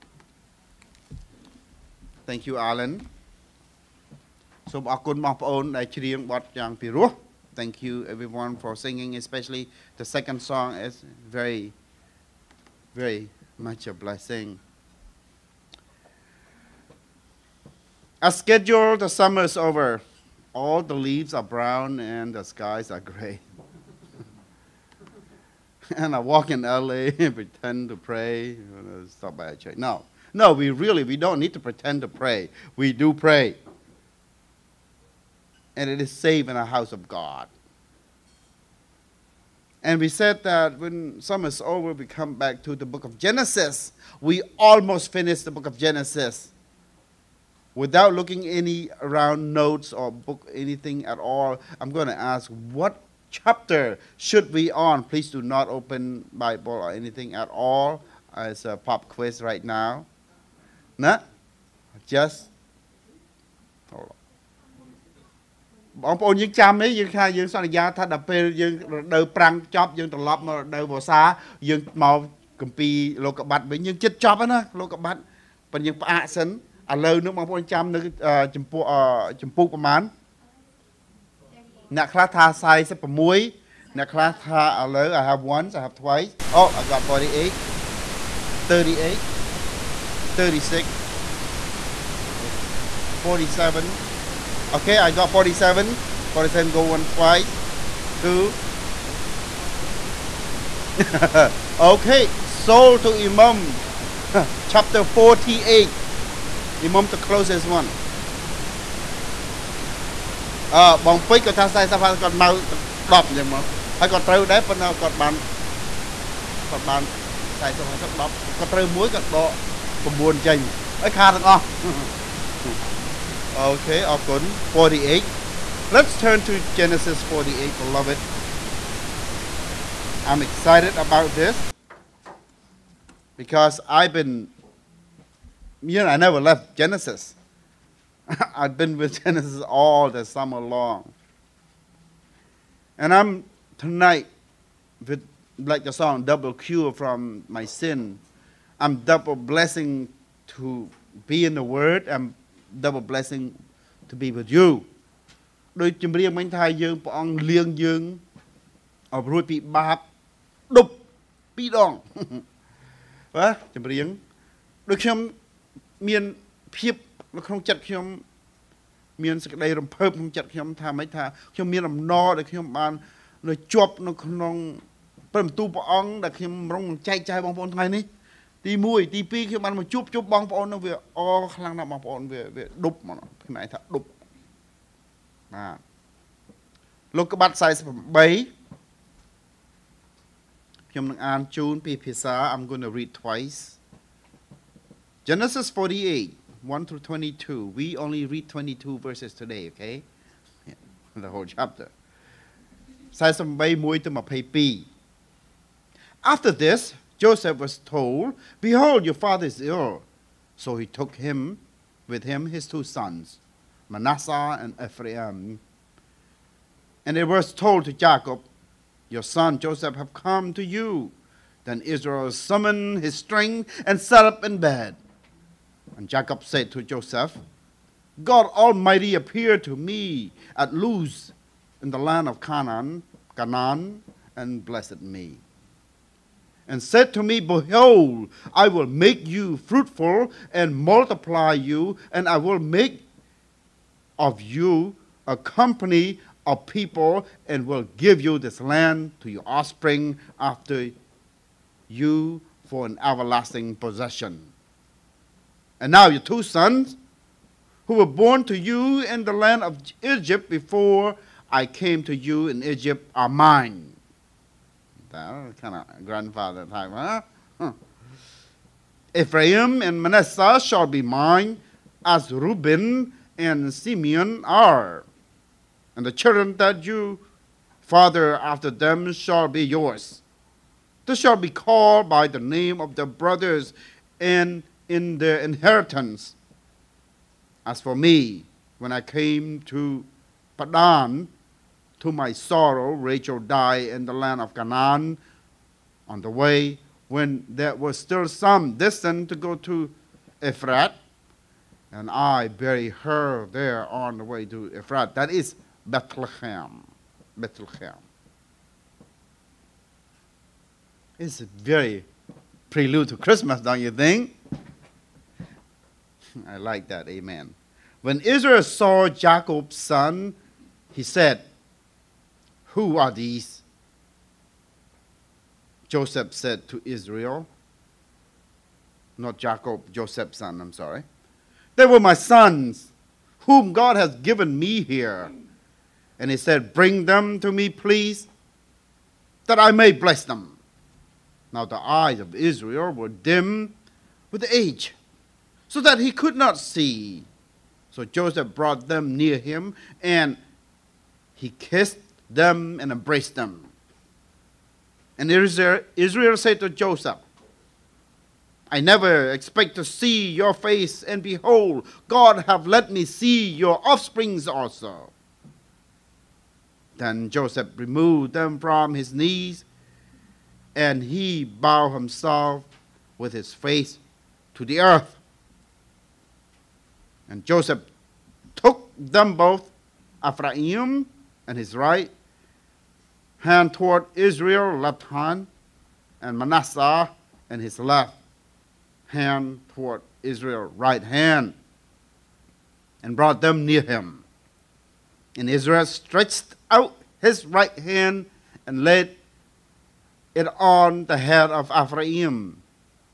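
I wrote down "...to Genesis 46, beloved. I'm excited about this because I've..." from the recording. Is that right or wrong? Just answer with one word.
wrong.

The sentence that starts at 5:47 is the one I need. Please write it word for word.
So Joseph brought them near him, and he kissed them and embraced them.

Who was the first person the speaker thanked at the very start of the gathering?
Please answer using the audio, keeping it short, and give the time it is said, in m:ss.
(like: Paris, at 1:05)
Alan, at 0:02.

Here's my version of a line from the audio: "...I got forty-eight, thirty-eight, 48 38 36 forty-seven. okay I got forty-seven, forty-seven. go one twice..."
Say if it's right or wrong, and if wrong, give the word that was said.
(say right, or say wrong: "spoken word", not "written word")
right.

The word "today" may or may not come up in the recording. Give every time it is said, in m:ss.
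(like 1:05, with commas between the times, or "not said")
3:19.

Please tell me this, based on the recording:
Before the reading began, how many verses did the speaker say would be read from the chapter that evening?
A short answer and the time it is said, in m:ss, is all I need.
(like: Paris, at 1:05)
22, at 3:18.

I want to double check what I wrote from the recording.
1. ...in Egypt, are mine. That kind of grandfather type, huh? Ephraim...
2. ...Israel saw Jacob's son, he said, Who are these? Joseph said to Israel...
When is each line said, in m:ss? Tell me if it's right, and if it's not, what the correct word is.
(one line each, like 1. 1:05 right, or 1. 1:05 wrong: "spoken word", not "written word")
1. 4:22 right
2. 5:18 right.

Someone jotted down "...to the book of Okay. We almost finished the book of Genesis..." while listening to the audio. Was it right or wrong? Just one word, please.
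wrong.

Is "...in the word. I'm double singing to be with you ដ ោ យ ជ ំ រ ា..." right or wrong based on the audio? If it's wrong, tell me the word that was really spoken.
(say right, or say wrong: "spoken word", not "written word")
wrong: "blessing", not "singing".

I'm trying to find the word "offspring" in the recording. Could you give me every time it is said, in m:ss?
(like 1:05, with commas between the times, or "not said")
4:09, 6:03.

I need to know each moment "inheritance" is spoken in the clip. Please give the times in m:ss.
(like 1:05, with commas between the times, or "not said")
4:45.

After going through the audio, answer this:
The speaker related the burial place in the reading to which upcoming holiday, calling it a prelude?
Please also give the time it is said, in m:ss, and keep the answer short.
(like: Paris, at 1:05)
Christmas, at 5:13.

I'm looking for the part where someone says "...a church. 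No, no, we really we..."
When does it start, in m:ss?
0:29.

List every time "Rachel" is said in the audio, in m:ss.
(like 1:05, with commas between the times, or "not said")
4:52.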